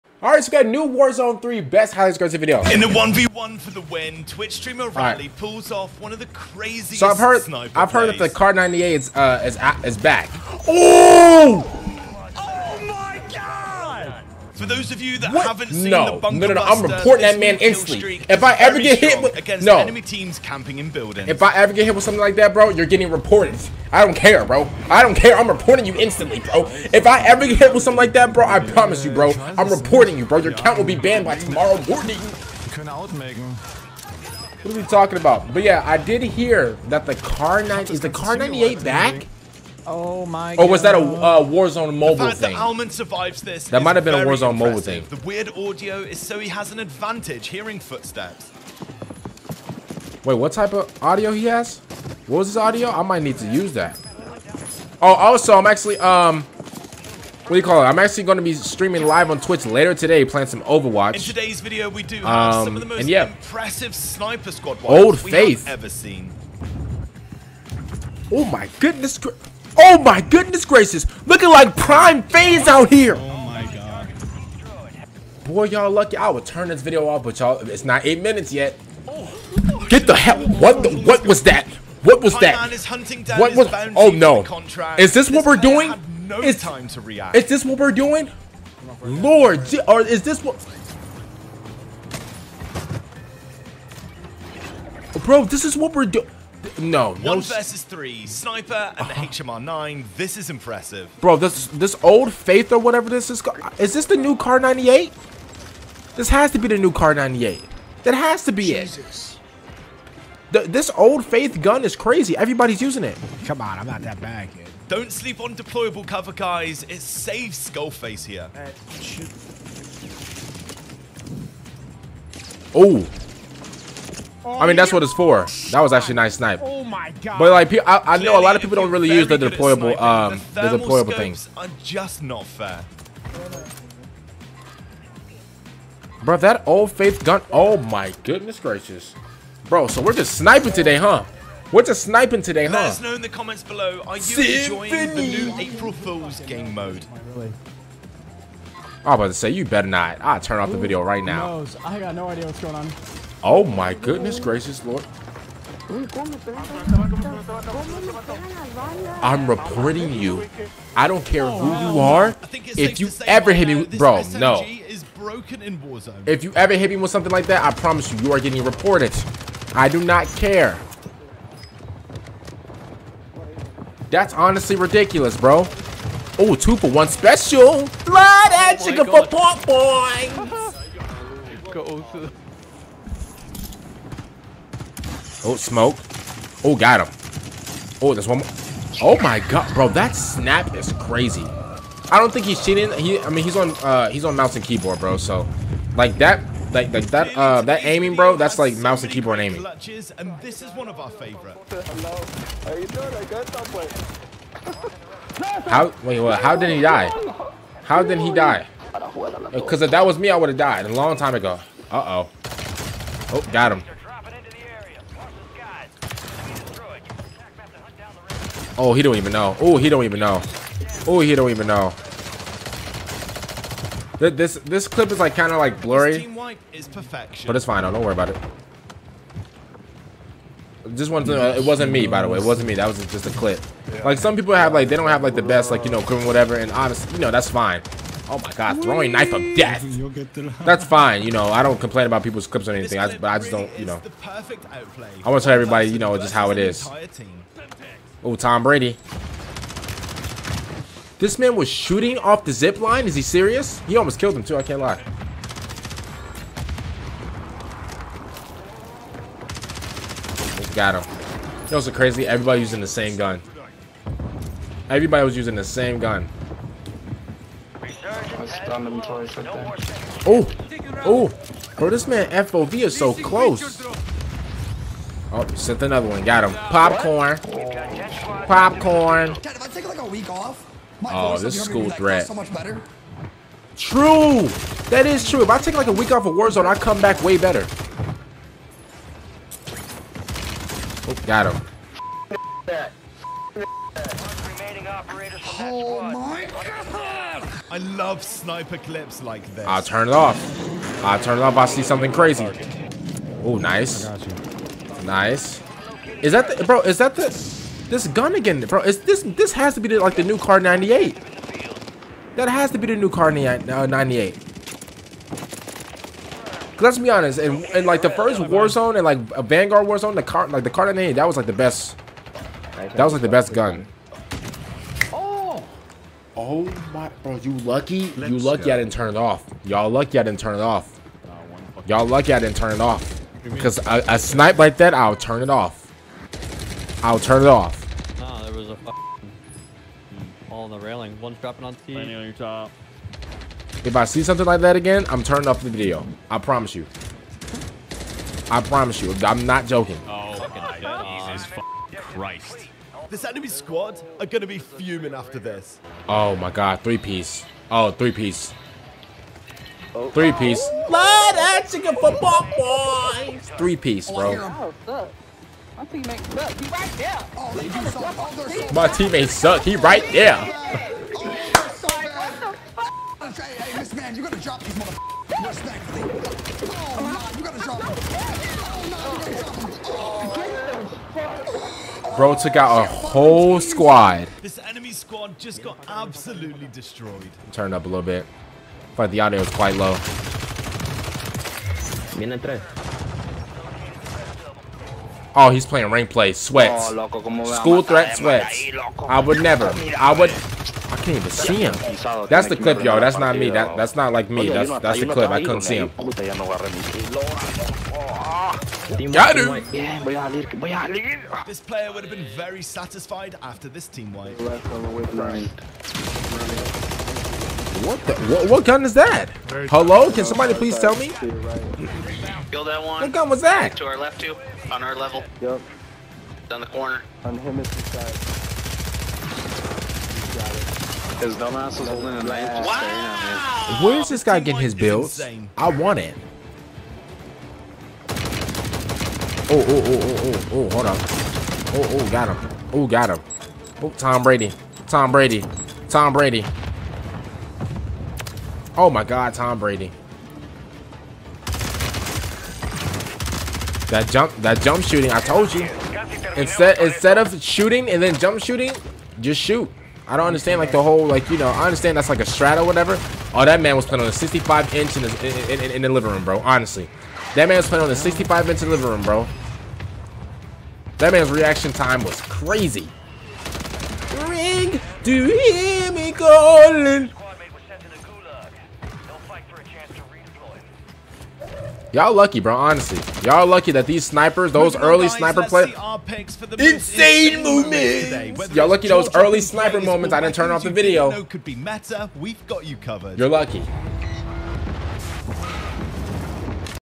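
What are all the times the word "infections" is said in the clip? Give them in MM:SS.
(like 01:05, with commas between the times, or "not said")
not said.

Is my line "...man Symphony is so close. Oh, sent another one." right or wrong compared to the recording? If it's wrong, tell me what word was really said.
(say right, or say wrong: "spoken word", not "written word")
wrong: "FOV", not "Symphony".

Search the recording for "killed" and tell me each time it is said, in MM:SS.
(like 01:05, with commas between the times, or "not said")
04:14.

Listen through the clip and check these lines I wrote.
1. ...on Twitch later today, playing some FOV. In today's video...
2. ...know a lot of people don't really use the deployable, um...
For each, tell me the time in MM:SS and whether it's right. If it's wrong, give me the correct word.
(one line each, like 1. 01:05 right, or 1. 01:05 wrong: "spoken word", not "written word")
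1. 00:59 wrong: "Overwatch", not "FOV"
2. 02:08 right.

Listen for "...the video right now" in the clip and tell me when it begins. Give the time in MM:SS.
02:30.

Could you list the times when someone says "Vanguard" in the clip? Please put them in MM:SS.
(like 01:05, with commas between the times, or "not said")
05:19.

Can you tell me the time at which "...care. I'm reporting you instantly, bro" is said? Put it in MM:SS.
00:25.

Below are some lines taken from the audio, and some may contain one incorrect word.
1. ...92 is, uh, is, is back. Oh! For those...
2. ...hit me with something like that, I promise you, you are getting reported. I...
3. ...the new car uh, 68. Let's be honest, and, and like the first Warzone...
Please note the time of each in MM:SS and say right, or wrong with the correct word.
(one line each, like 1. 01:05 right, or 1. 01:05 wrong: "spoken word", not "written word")
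1. 00:08 wrong: "98", not "92"
2. 02:46 right
3. 05:12 wrong: "98", not "68".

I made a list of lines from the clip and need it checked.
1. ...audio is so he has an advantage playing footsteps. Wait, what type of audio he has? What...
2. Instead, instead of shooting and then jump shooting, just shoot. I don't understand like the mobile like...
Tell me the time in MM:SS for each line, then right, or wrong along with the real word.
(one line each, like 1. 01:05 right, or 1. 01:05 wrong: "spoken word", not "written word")
1. 00:45 wrong: "hearing", not "playing"
2. 07:36 wrong: "whole", not "mobile".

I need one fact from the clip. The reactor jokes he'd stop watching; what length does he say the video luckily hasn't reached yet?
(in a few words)
8 minutes.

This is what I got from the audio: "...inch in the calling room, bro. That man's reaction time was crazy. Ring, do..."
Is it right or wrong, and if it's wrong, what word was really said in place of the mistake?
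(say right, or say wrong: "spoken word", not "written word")
wrong: "living", not "calling".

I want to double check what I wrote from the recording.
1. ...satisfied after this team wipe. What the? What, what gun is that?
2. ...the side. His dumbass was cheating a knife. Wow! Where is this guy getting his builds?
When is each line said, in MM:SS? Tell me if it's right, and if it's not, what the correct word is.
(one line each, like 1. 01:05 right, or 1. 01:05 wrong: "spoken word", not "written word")
1. 06:52 right
2. 07:07 wrong: "holding", not "cheating".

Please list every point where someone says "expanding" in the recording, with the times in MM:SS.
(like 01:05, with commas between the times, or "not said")
not said.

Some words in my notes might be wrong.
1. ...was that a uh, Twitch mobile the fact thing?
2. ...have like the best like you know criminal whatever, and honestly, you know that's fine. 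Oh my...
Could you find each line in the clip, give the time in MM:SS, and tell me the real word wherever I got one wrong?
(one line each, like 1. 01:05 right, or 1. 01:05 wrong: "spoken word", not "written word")
1. 00:40 wrong: "Warzone", not "Twitch"
2. 03:55 right.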